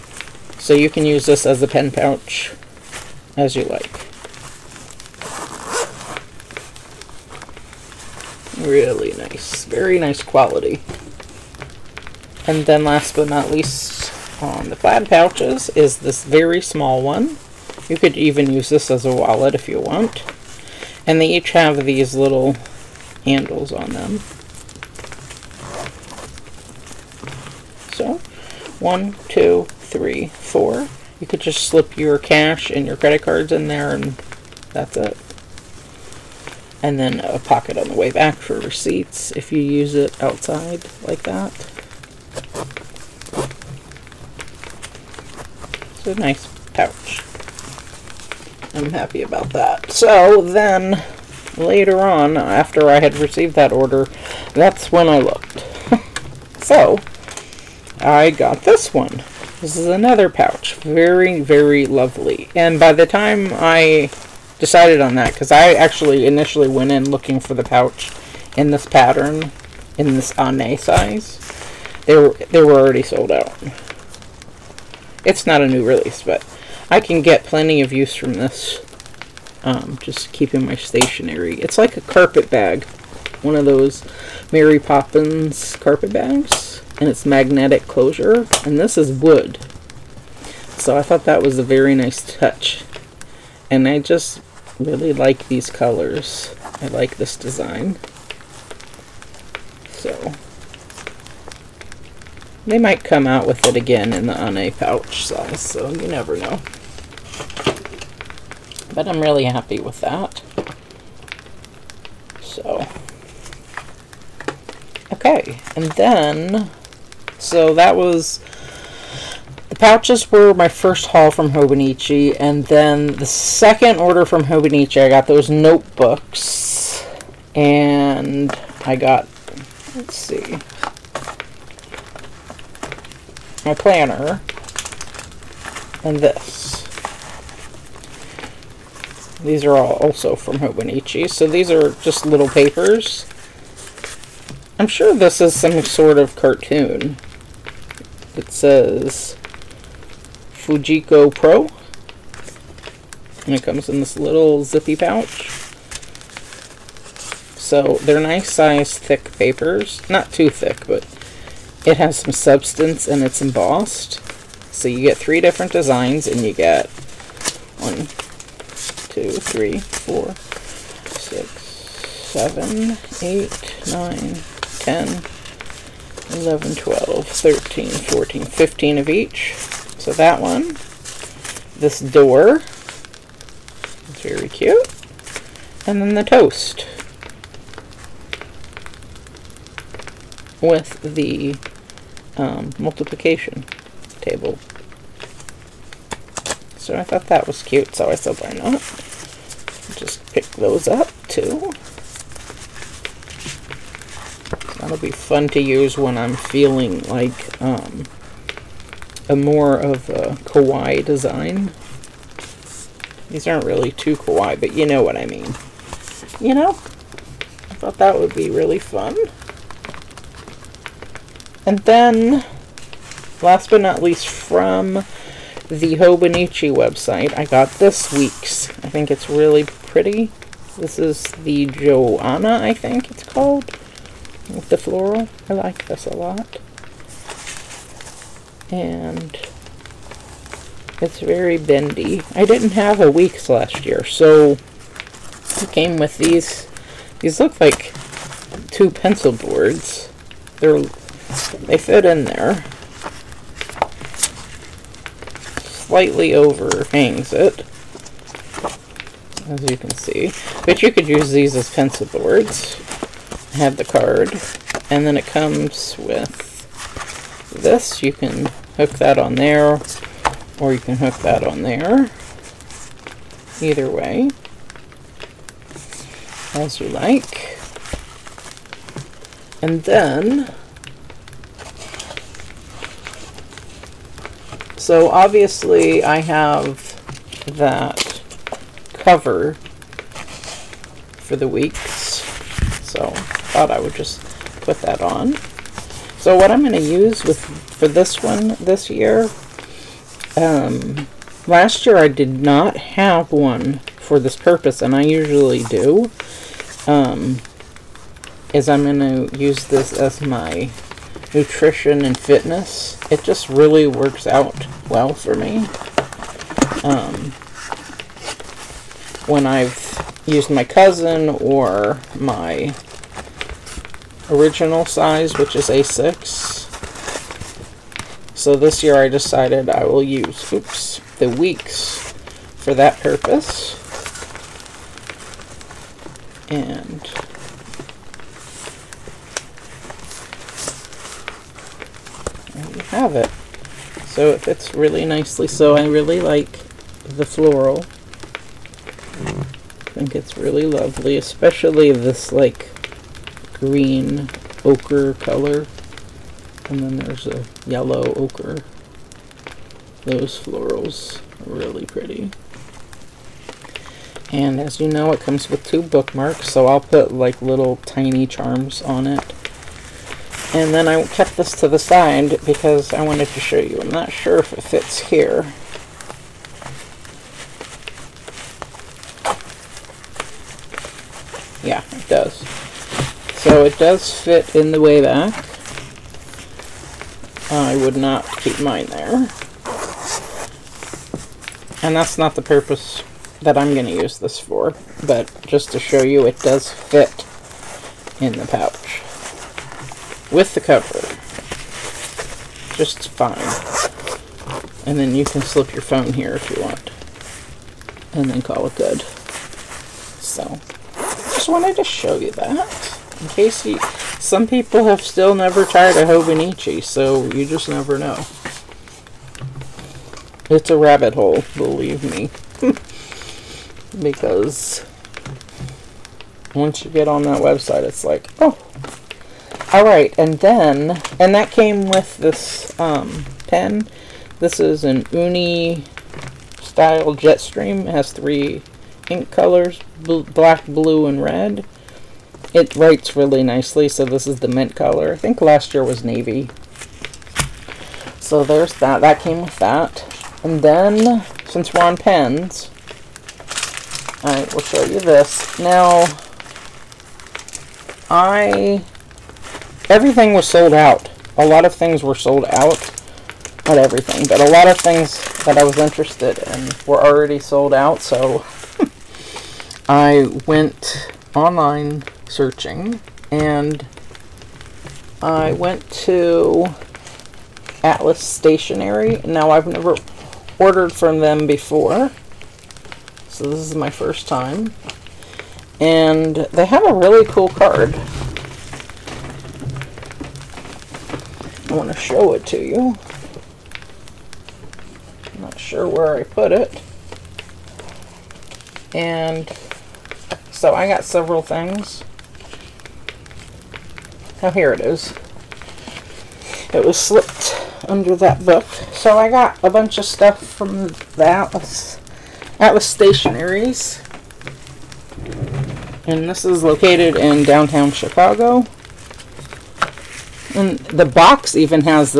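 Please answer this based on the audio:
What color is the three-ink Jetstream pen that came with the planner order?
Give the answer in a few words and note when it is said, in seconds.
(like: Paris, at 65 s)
Mint, at 444 s.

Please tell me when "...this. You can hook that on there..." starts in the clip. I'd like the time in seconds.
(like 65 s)
267 s.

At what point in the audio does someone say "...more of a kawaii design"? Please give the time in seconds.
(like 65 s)
209 s.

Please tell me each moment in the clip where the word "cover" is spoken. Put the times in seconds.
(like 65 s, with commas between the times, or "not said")
288 s, 400 s.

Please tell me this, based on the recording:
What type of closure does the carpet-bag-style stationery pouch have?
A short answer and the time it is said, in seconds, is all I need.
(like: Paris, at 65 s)
Magnetic closure, at 87 s.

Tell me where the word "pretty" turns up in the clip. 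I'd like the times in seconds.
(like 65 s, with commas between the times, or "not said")
229 s, 361 s.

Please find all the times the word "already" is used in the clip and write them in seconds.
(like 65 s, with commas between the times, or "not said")
72 s, 467 s.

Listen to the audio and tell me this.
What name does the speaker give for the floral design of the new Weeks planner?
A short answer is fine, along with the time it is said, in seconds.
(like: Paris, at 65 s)
Joanna, at 231 s.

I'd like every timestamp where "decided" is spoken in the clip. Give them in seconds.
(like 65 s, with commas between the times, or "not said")
64 s, 329 s.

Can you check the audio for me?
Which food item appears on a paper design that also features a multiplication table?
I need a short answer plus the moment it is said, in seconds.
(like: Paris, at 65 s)
Toast, at 186 s.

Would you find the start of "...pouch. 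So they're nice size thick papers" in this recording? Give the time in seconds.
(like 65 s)
154 s.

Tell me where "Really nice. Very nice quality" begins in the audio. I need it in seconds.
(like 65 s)
8 s.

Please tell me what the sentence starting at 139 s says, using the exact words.
These are all also from Hobonichi, so these are just little papers.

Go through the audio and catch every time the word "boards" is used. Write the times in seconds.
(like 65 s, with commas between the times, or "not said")
249 s, 262 s.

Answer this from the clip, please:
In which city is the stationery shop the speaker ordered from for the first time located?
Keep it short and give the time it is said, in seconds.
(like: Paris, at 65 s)
Chicago, at 517 s.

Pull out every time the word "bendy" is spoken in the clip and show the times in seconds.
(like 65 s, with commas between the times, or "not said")
241 s.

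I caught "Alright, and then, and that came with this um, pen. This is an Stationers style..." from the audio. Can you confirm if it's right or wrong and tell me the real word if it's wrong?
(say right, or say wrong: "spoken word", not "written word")
wrong: "Uni", not "Stationers".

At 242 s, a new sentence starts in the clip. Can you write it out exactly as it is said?
I didn't have a weeks last year, so it came with these.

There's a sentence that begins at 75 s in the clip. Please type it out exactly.
It's not a new release, but I can get plenty of use from this.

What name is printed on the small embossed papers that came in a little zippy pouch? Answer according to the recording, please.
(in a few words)
Fujiko Pro.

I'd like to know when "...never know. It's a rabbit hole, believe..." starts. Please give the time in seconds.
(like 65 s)
417 s.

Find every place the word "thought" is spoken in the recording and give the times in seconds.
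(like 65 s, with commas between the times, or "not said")
91 s, 197 s, 217 s, 293 s.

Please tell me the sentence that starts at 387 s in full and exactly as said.
I would not keep mine there.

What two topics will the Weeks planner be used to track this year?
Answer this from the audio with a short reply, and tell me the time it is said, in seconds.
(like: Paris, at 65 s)
Nutrition and fitness, at 311 s.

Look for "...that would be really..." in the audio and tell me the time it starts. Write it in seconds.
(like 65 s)
217 s.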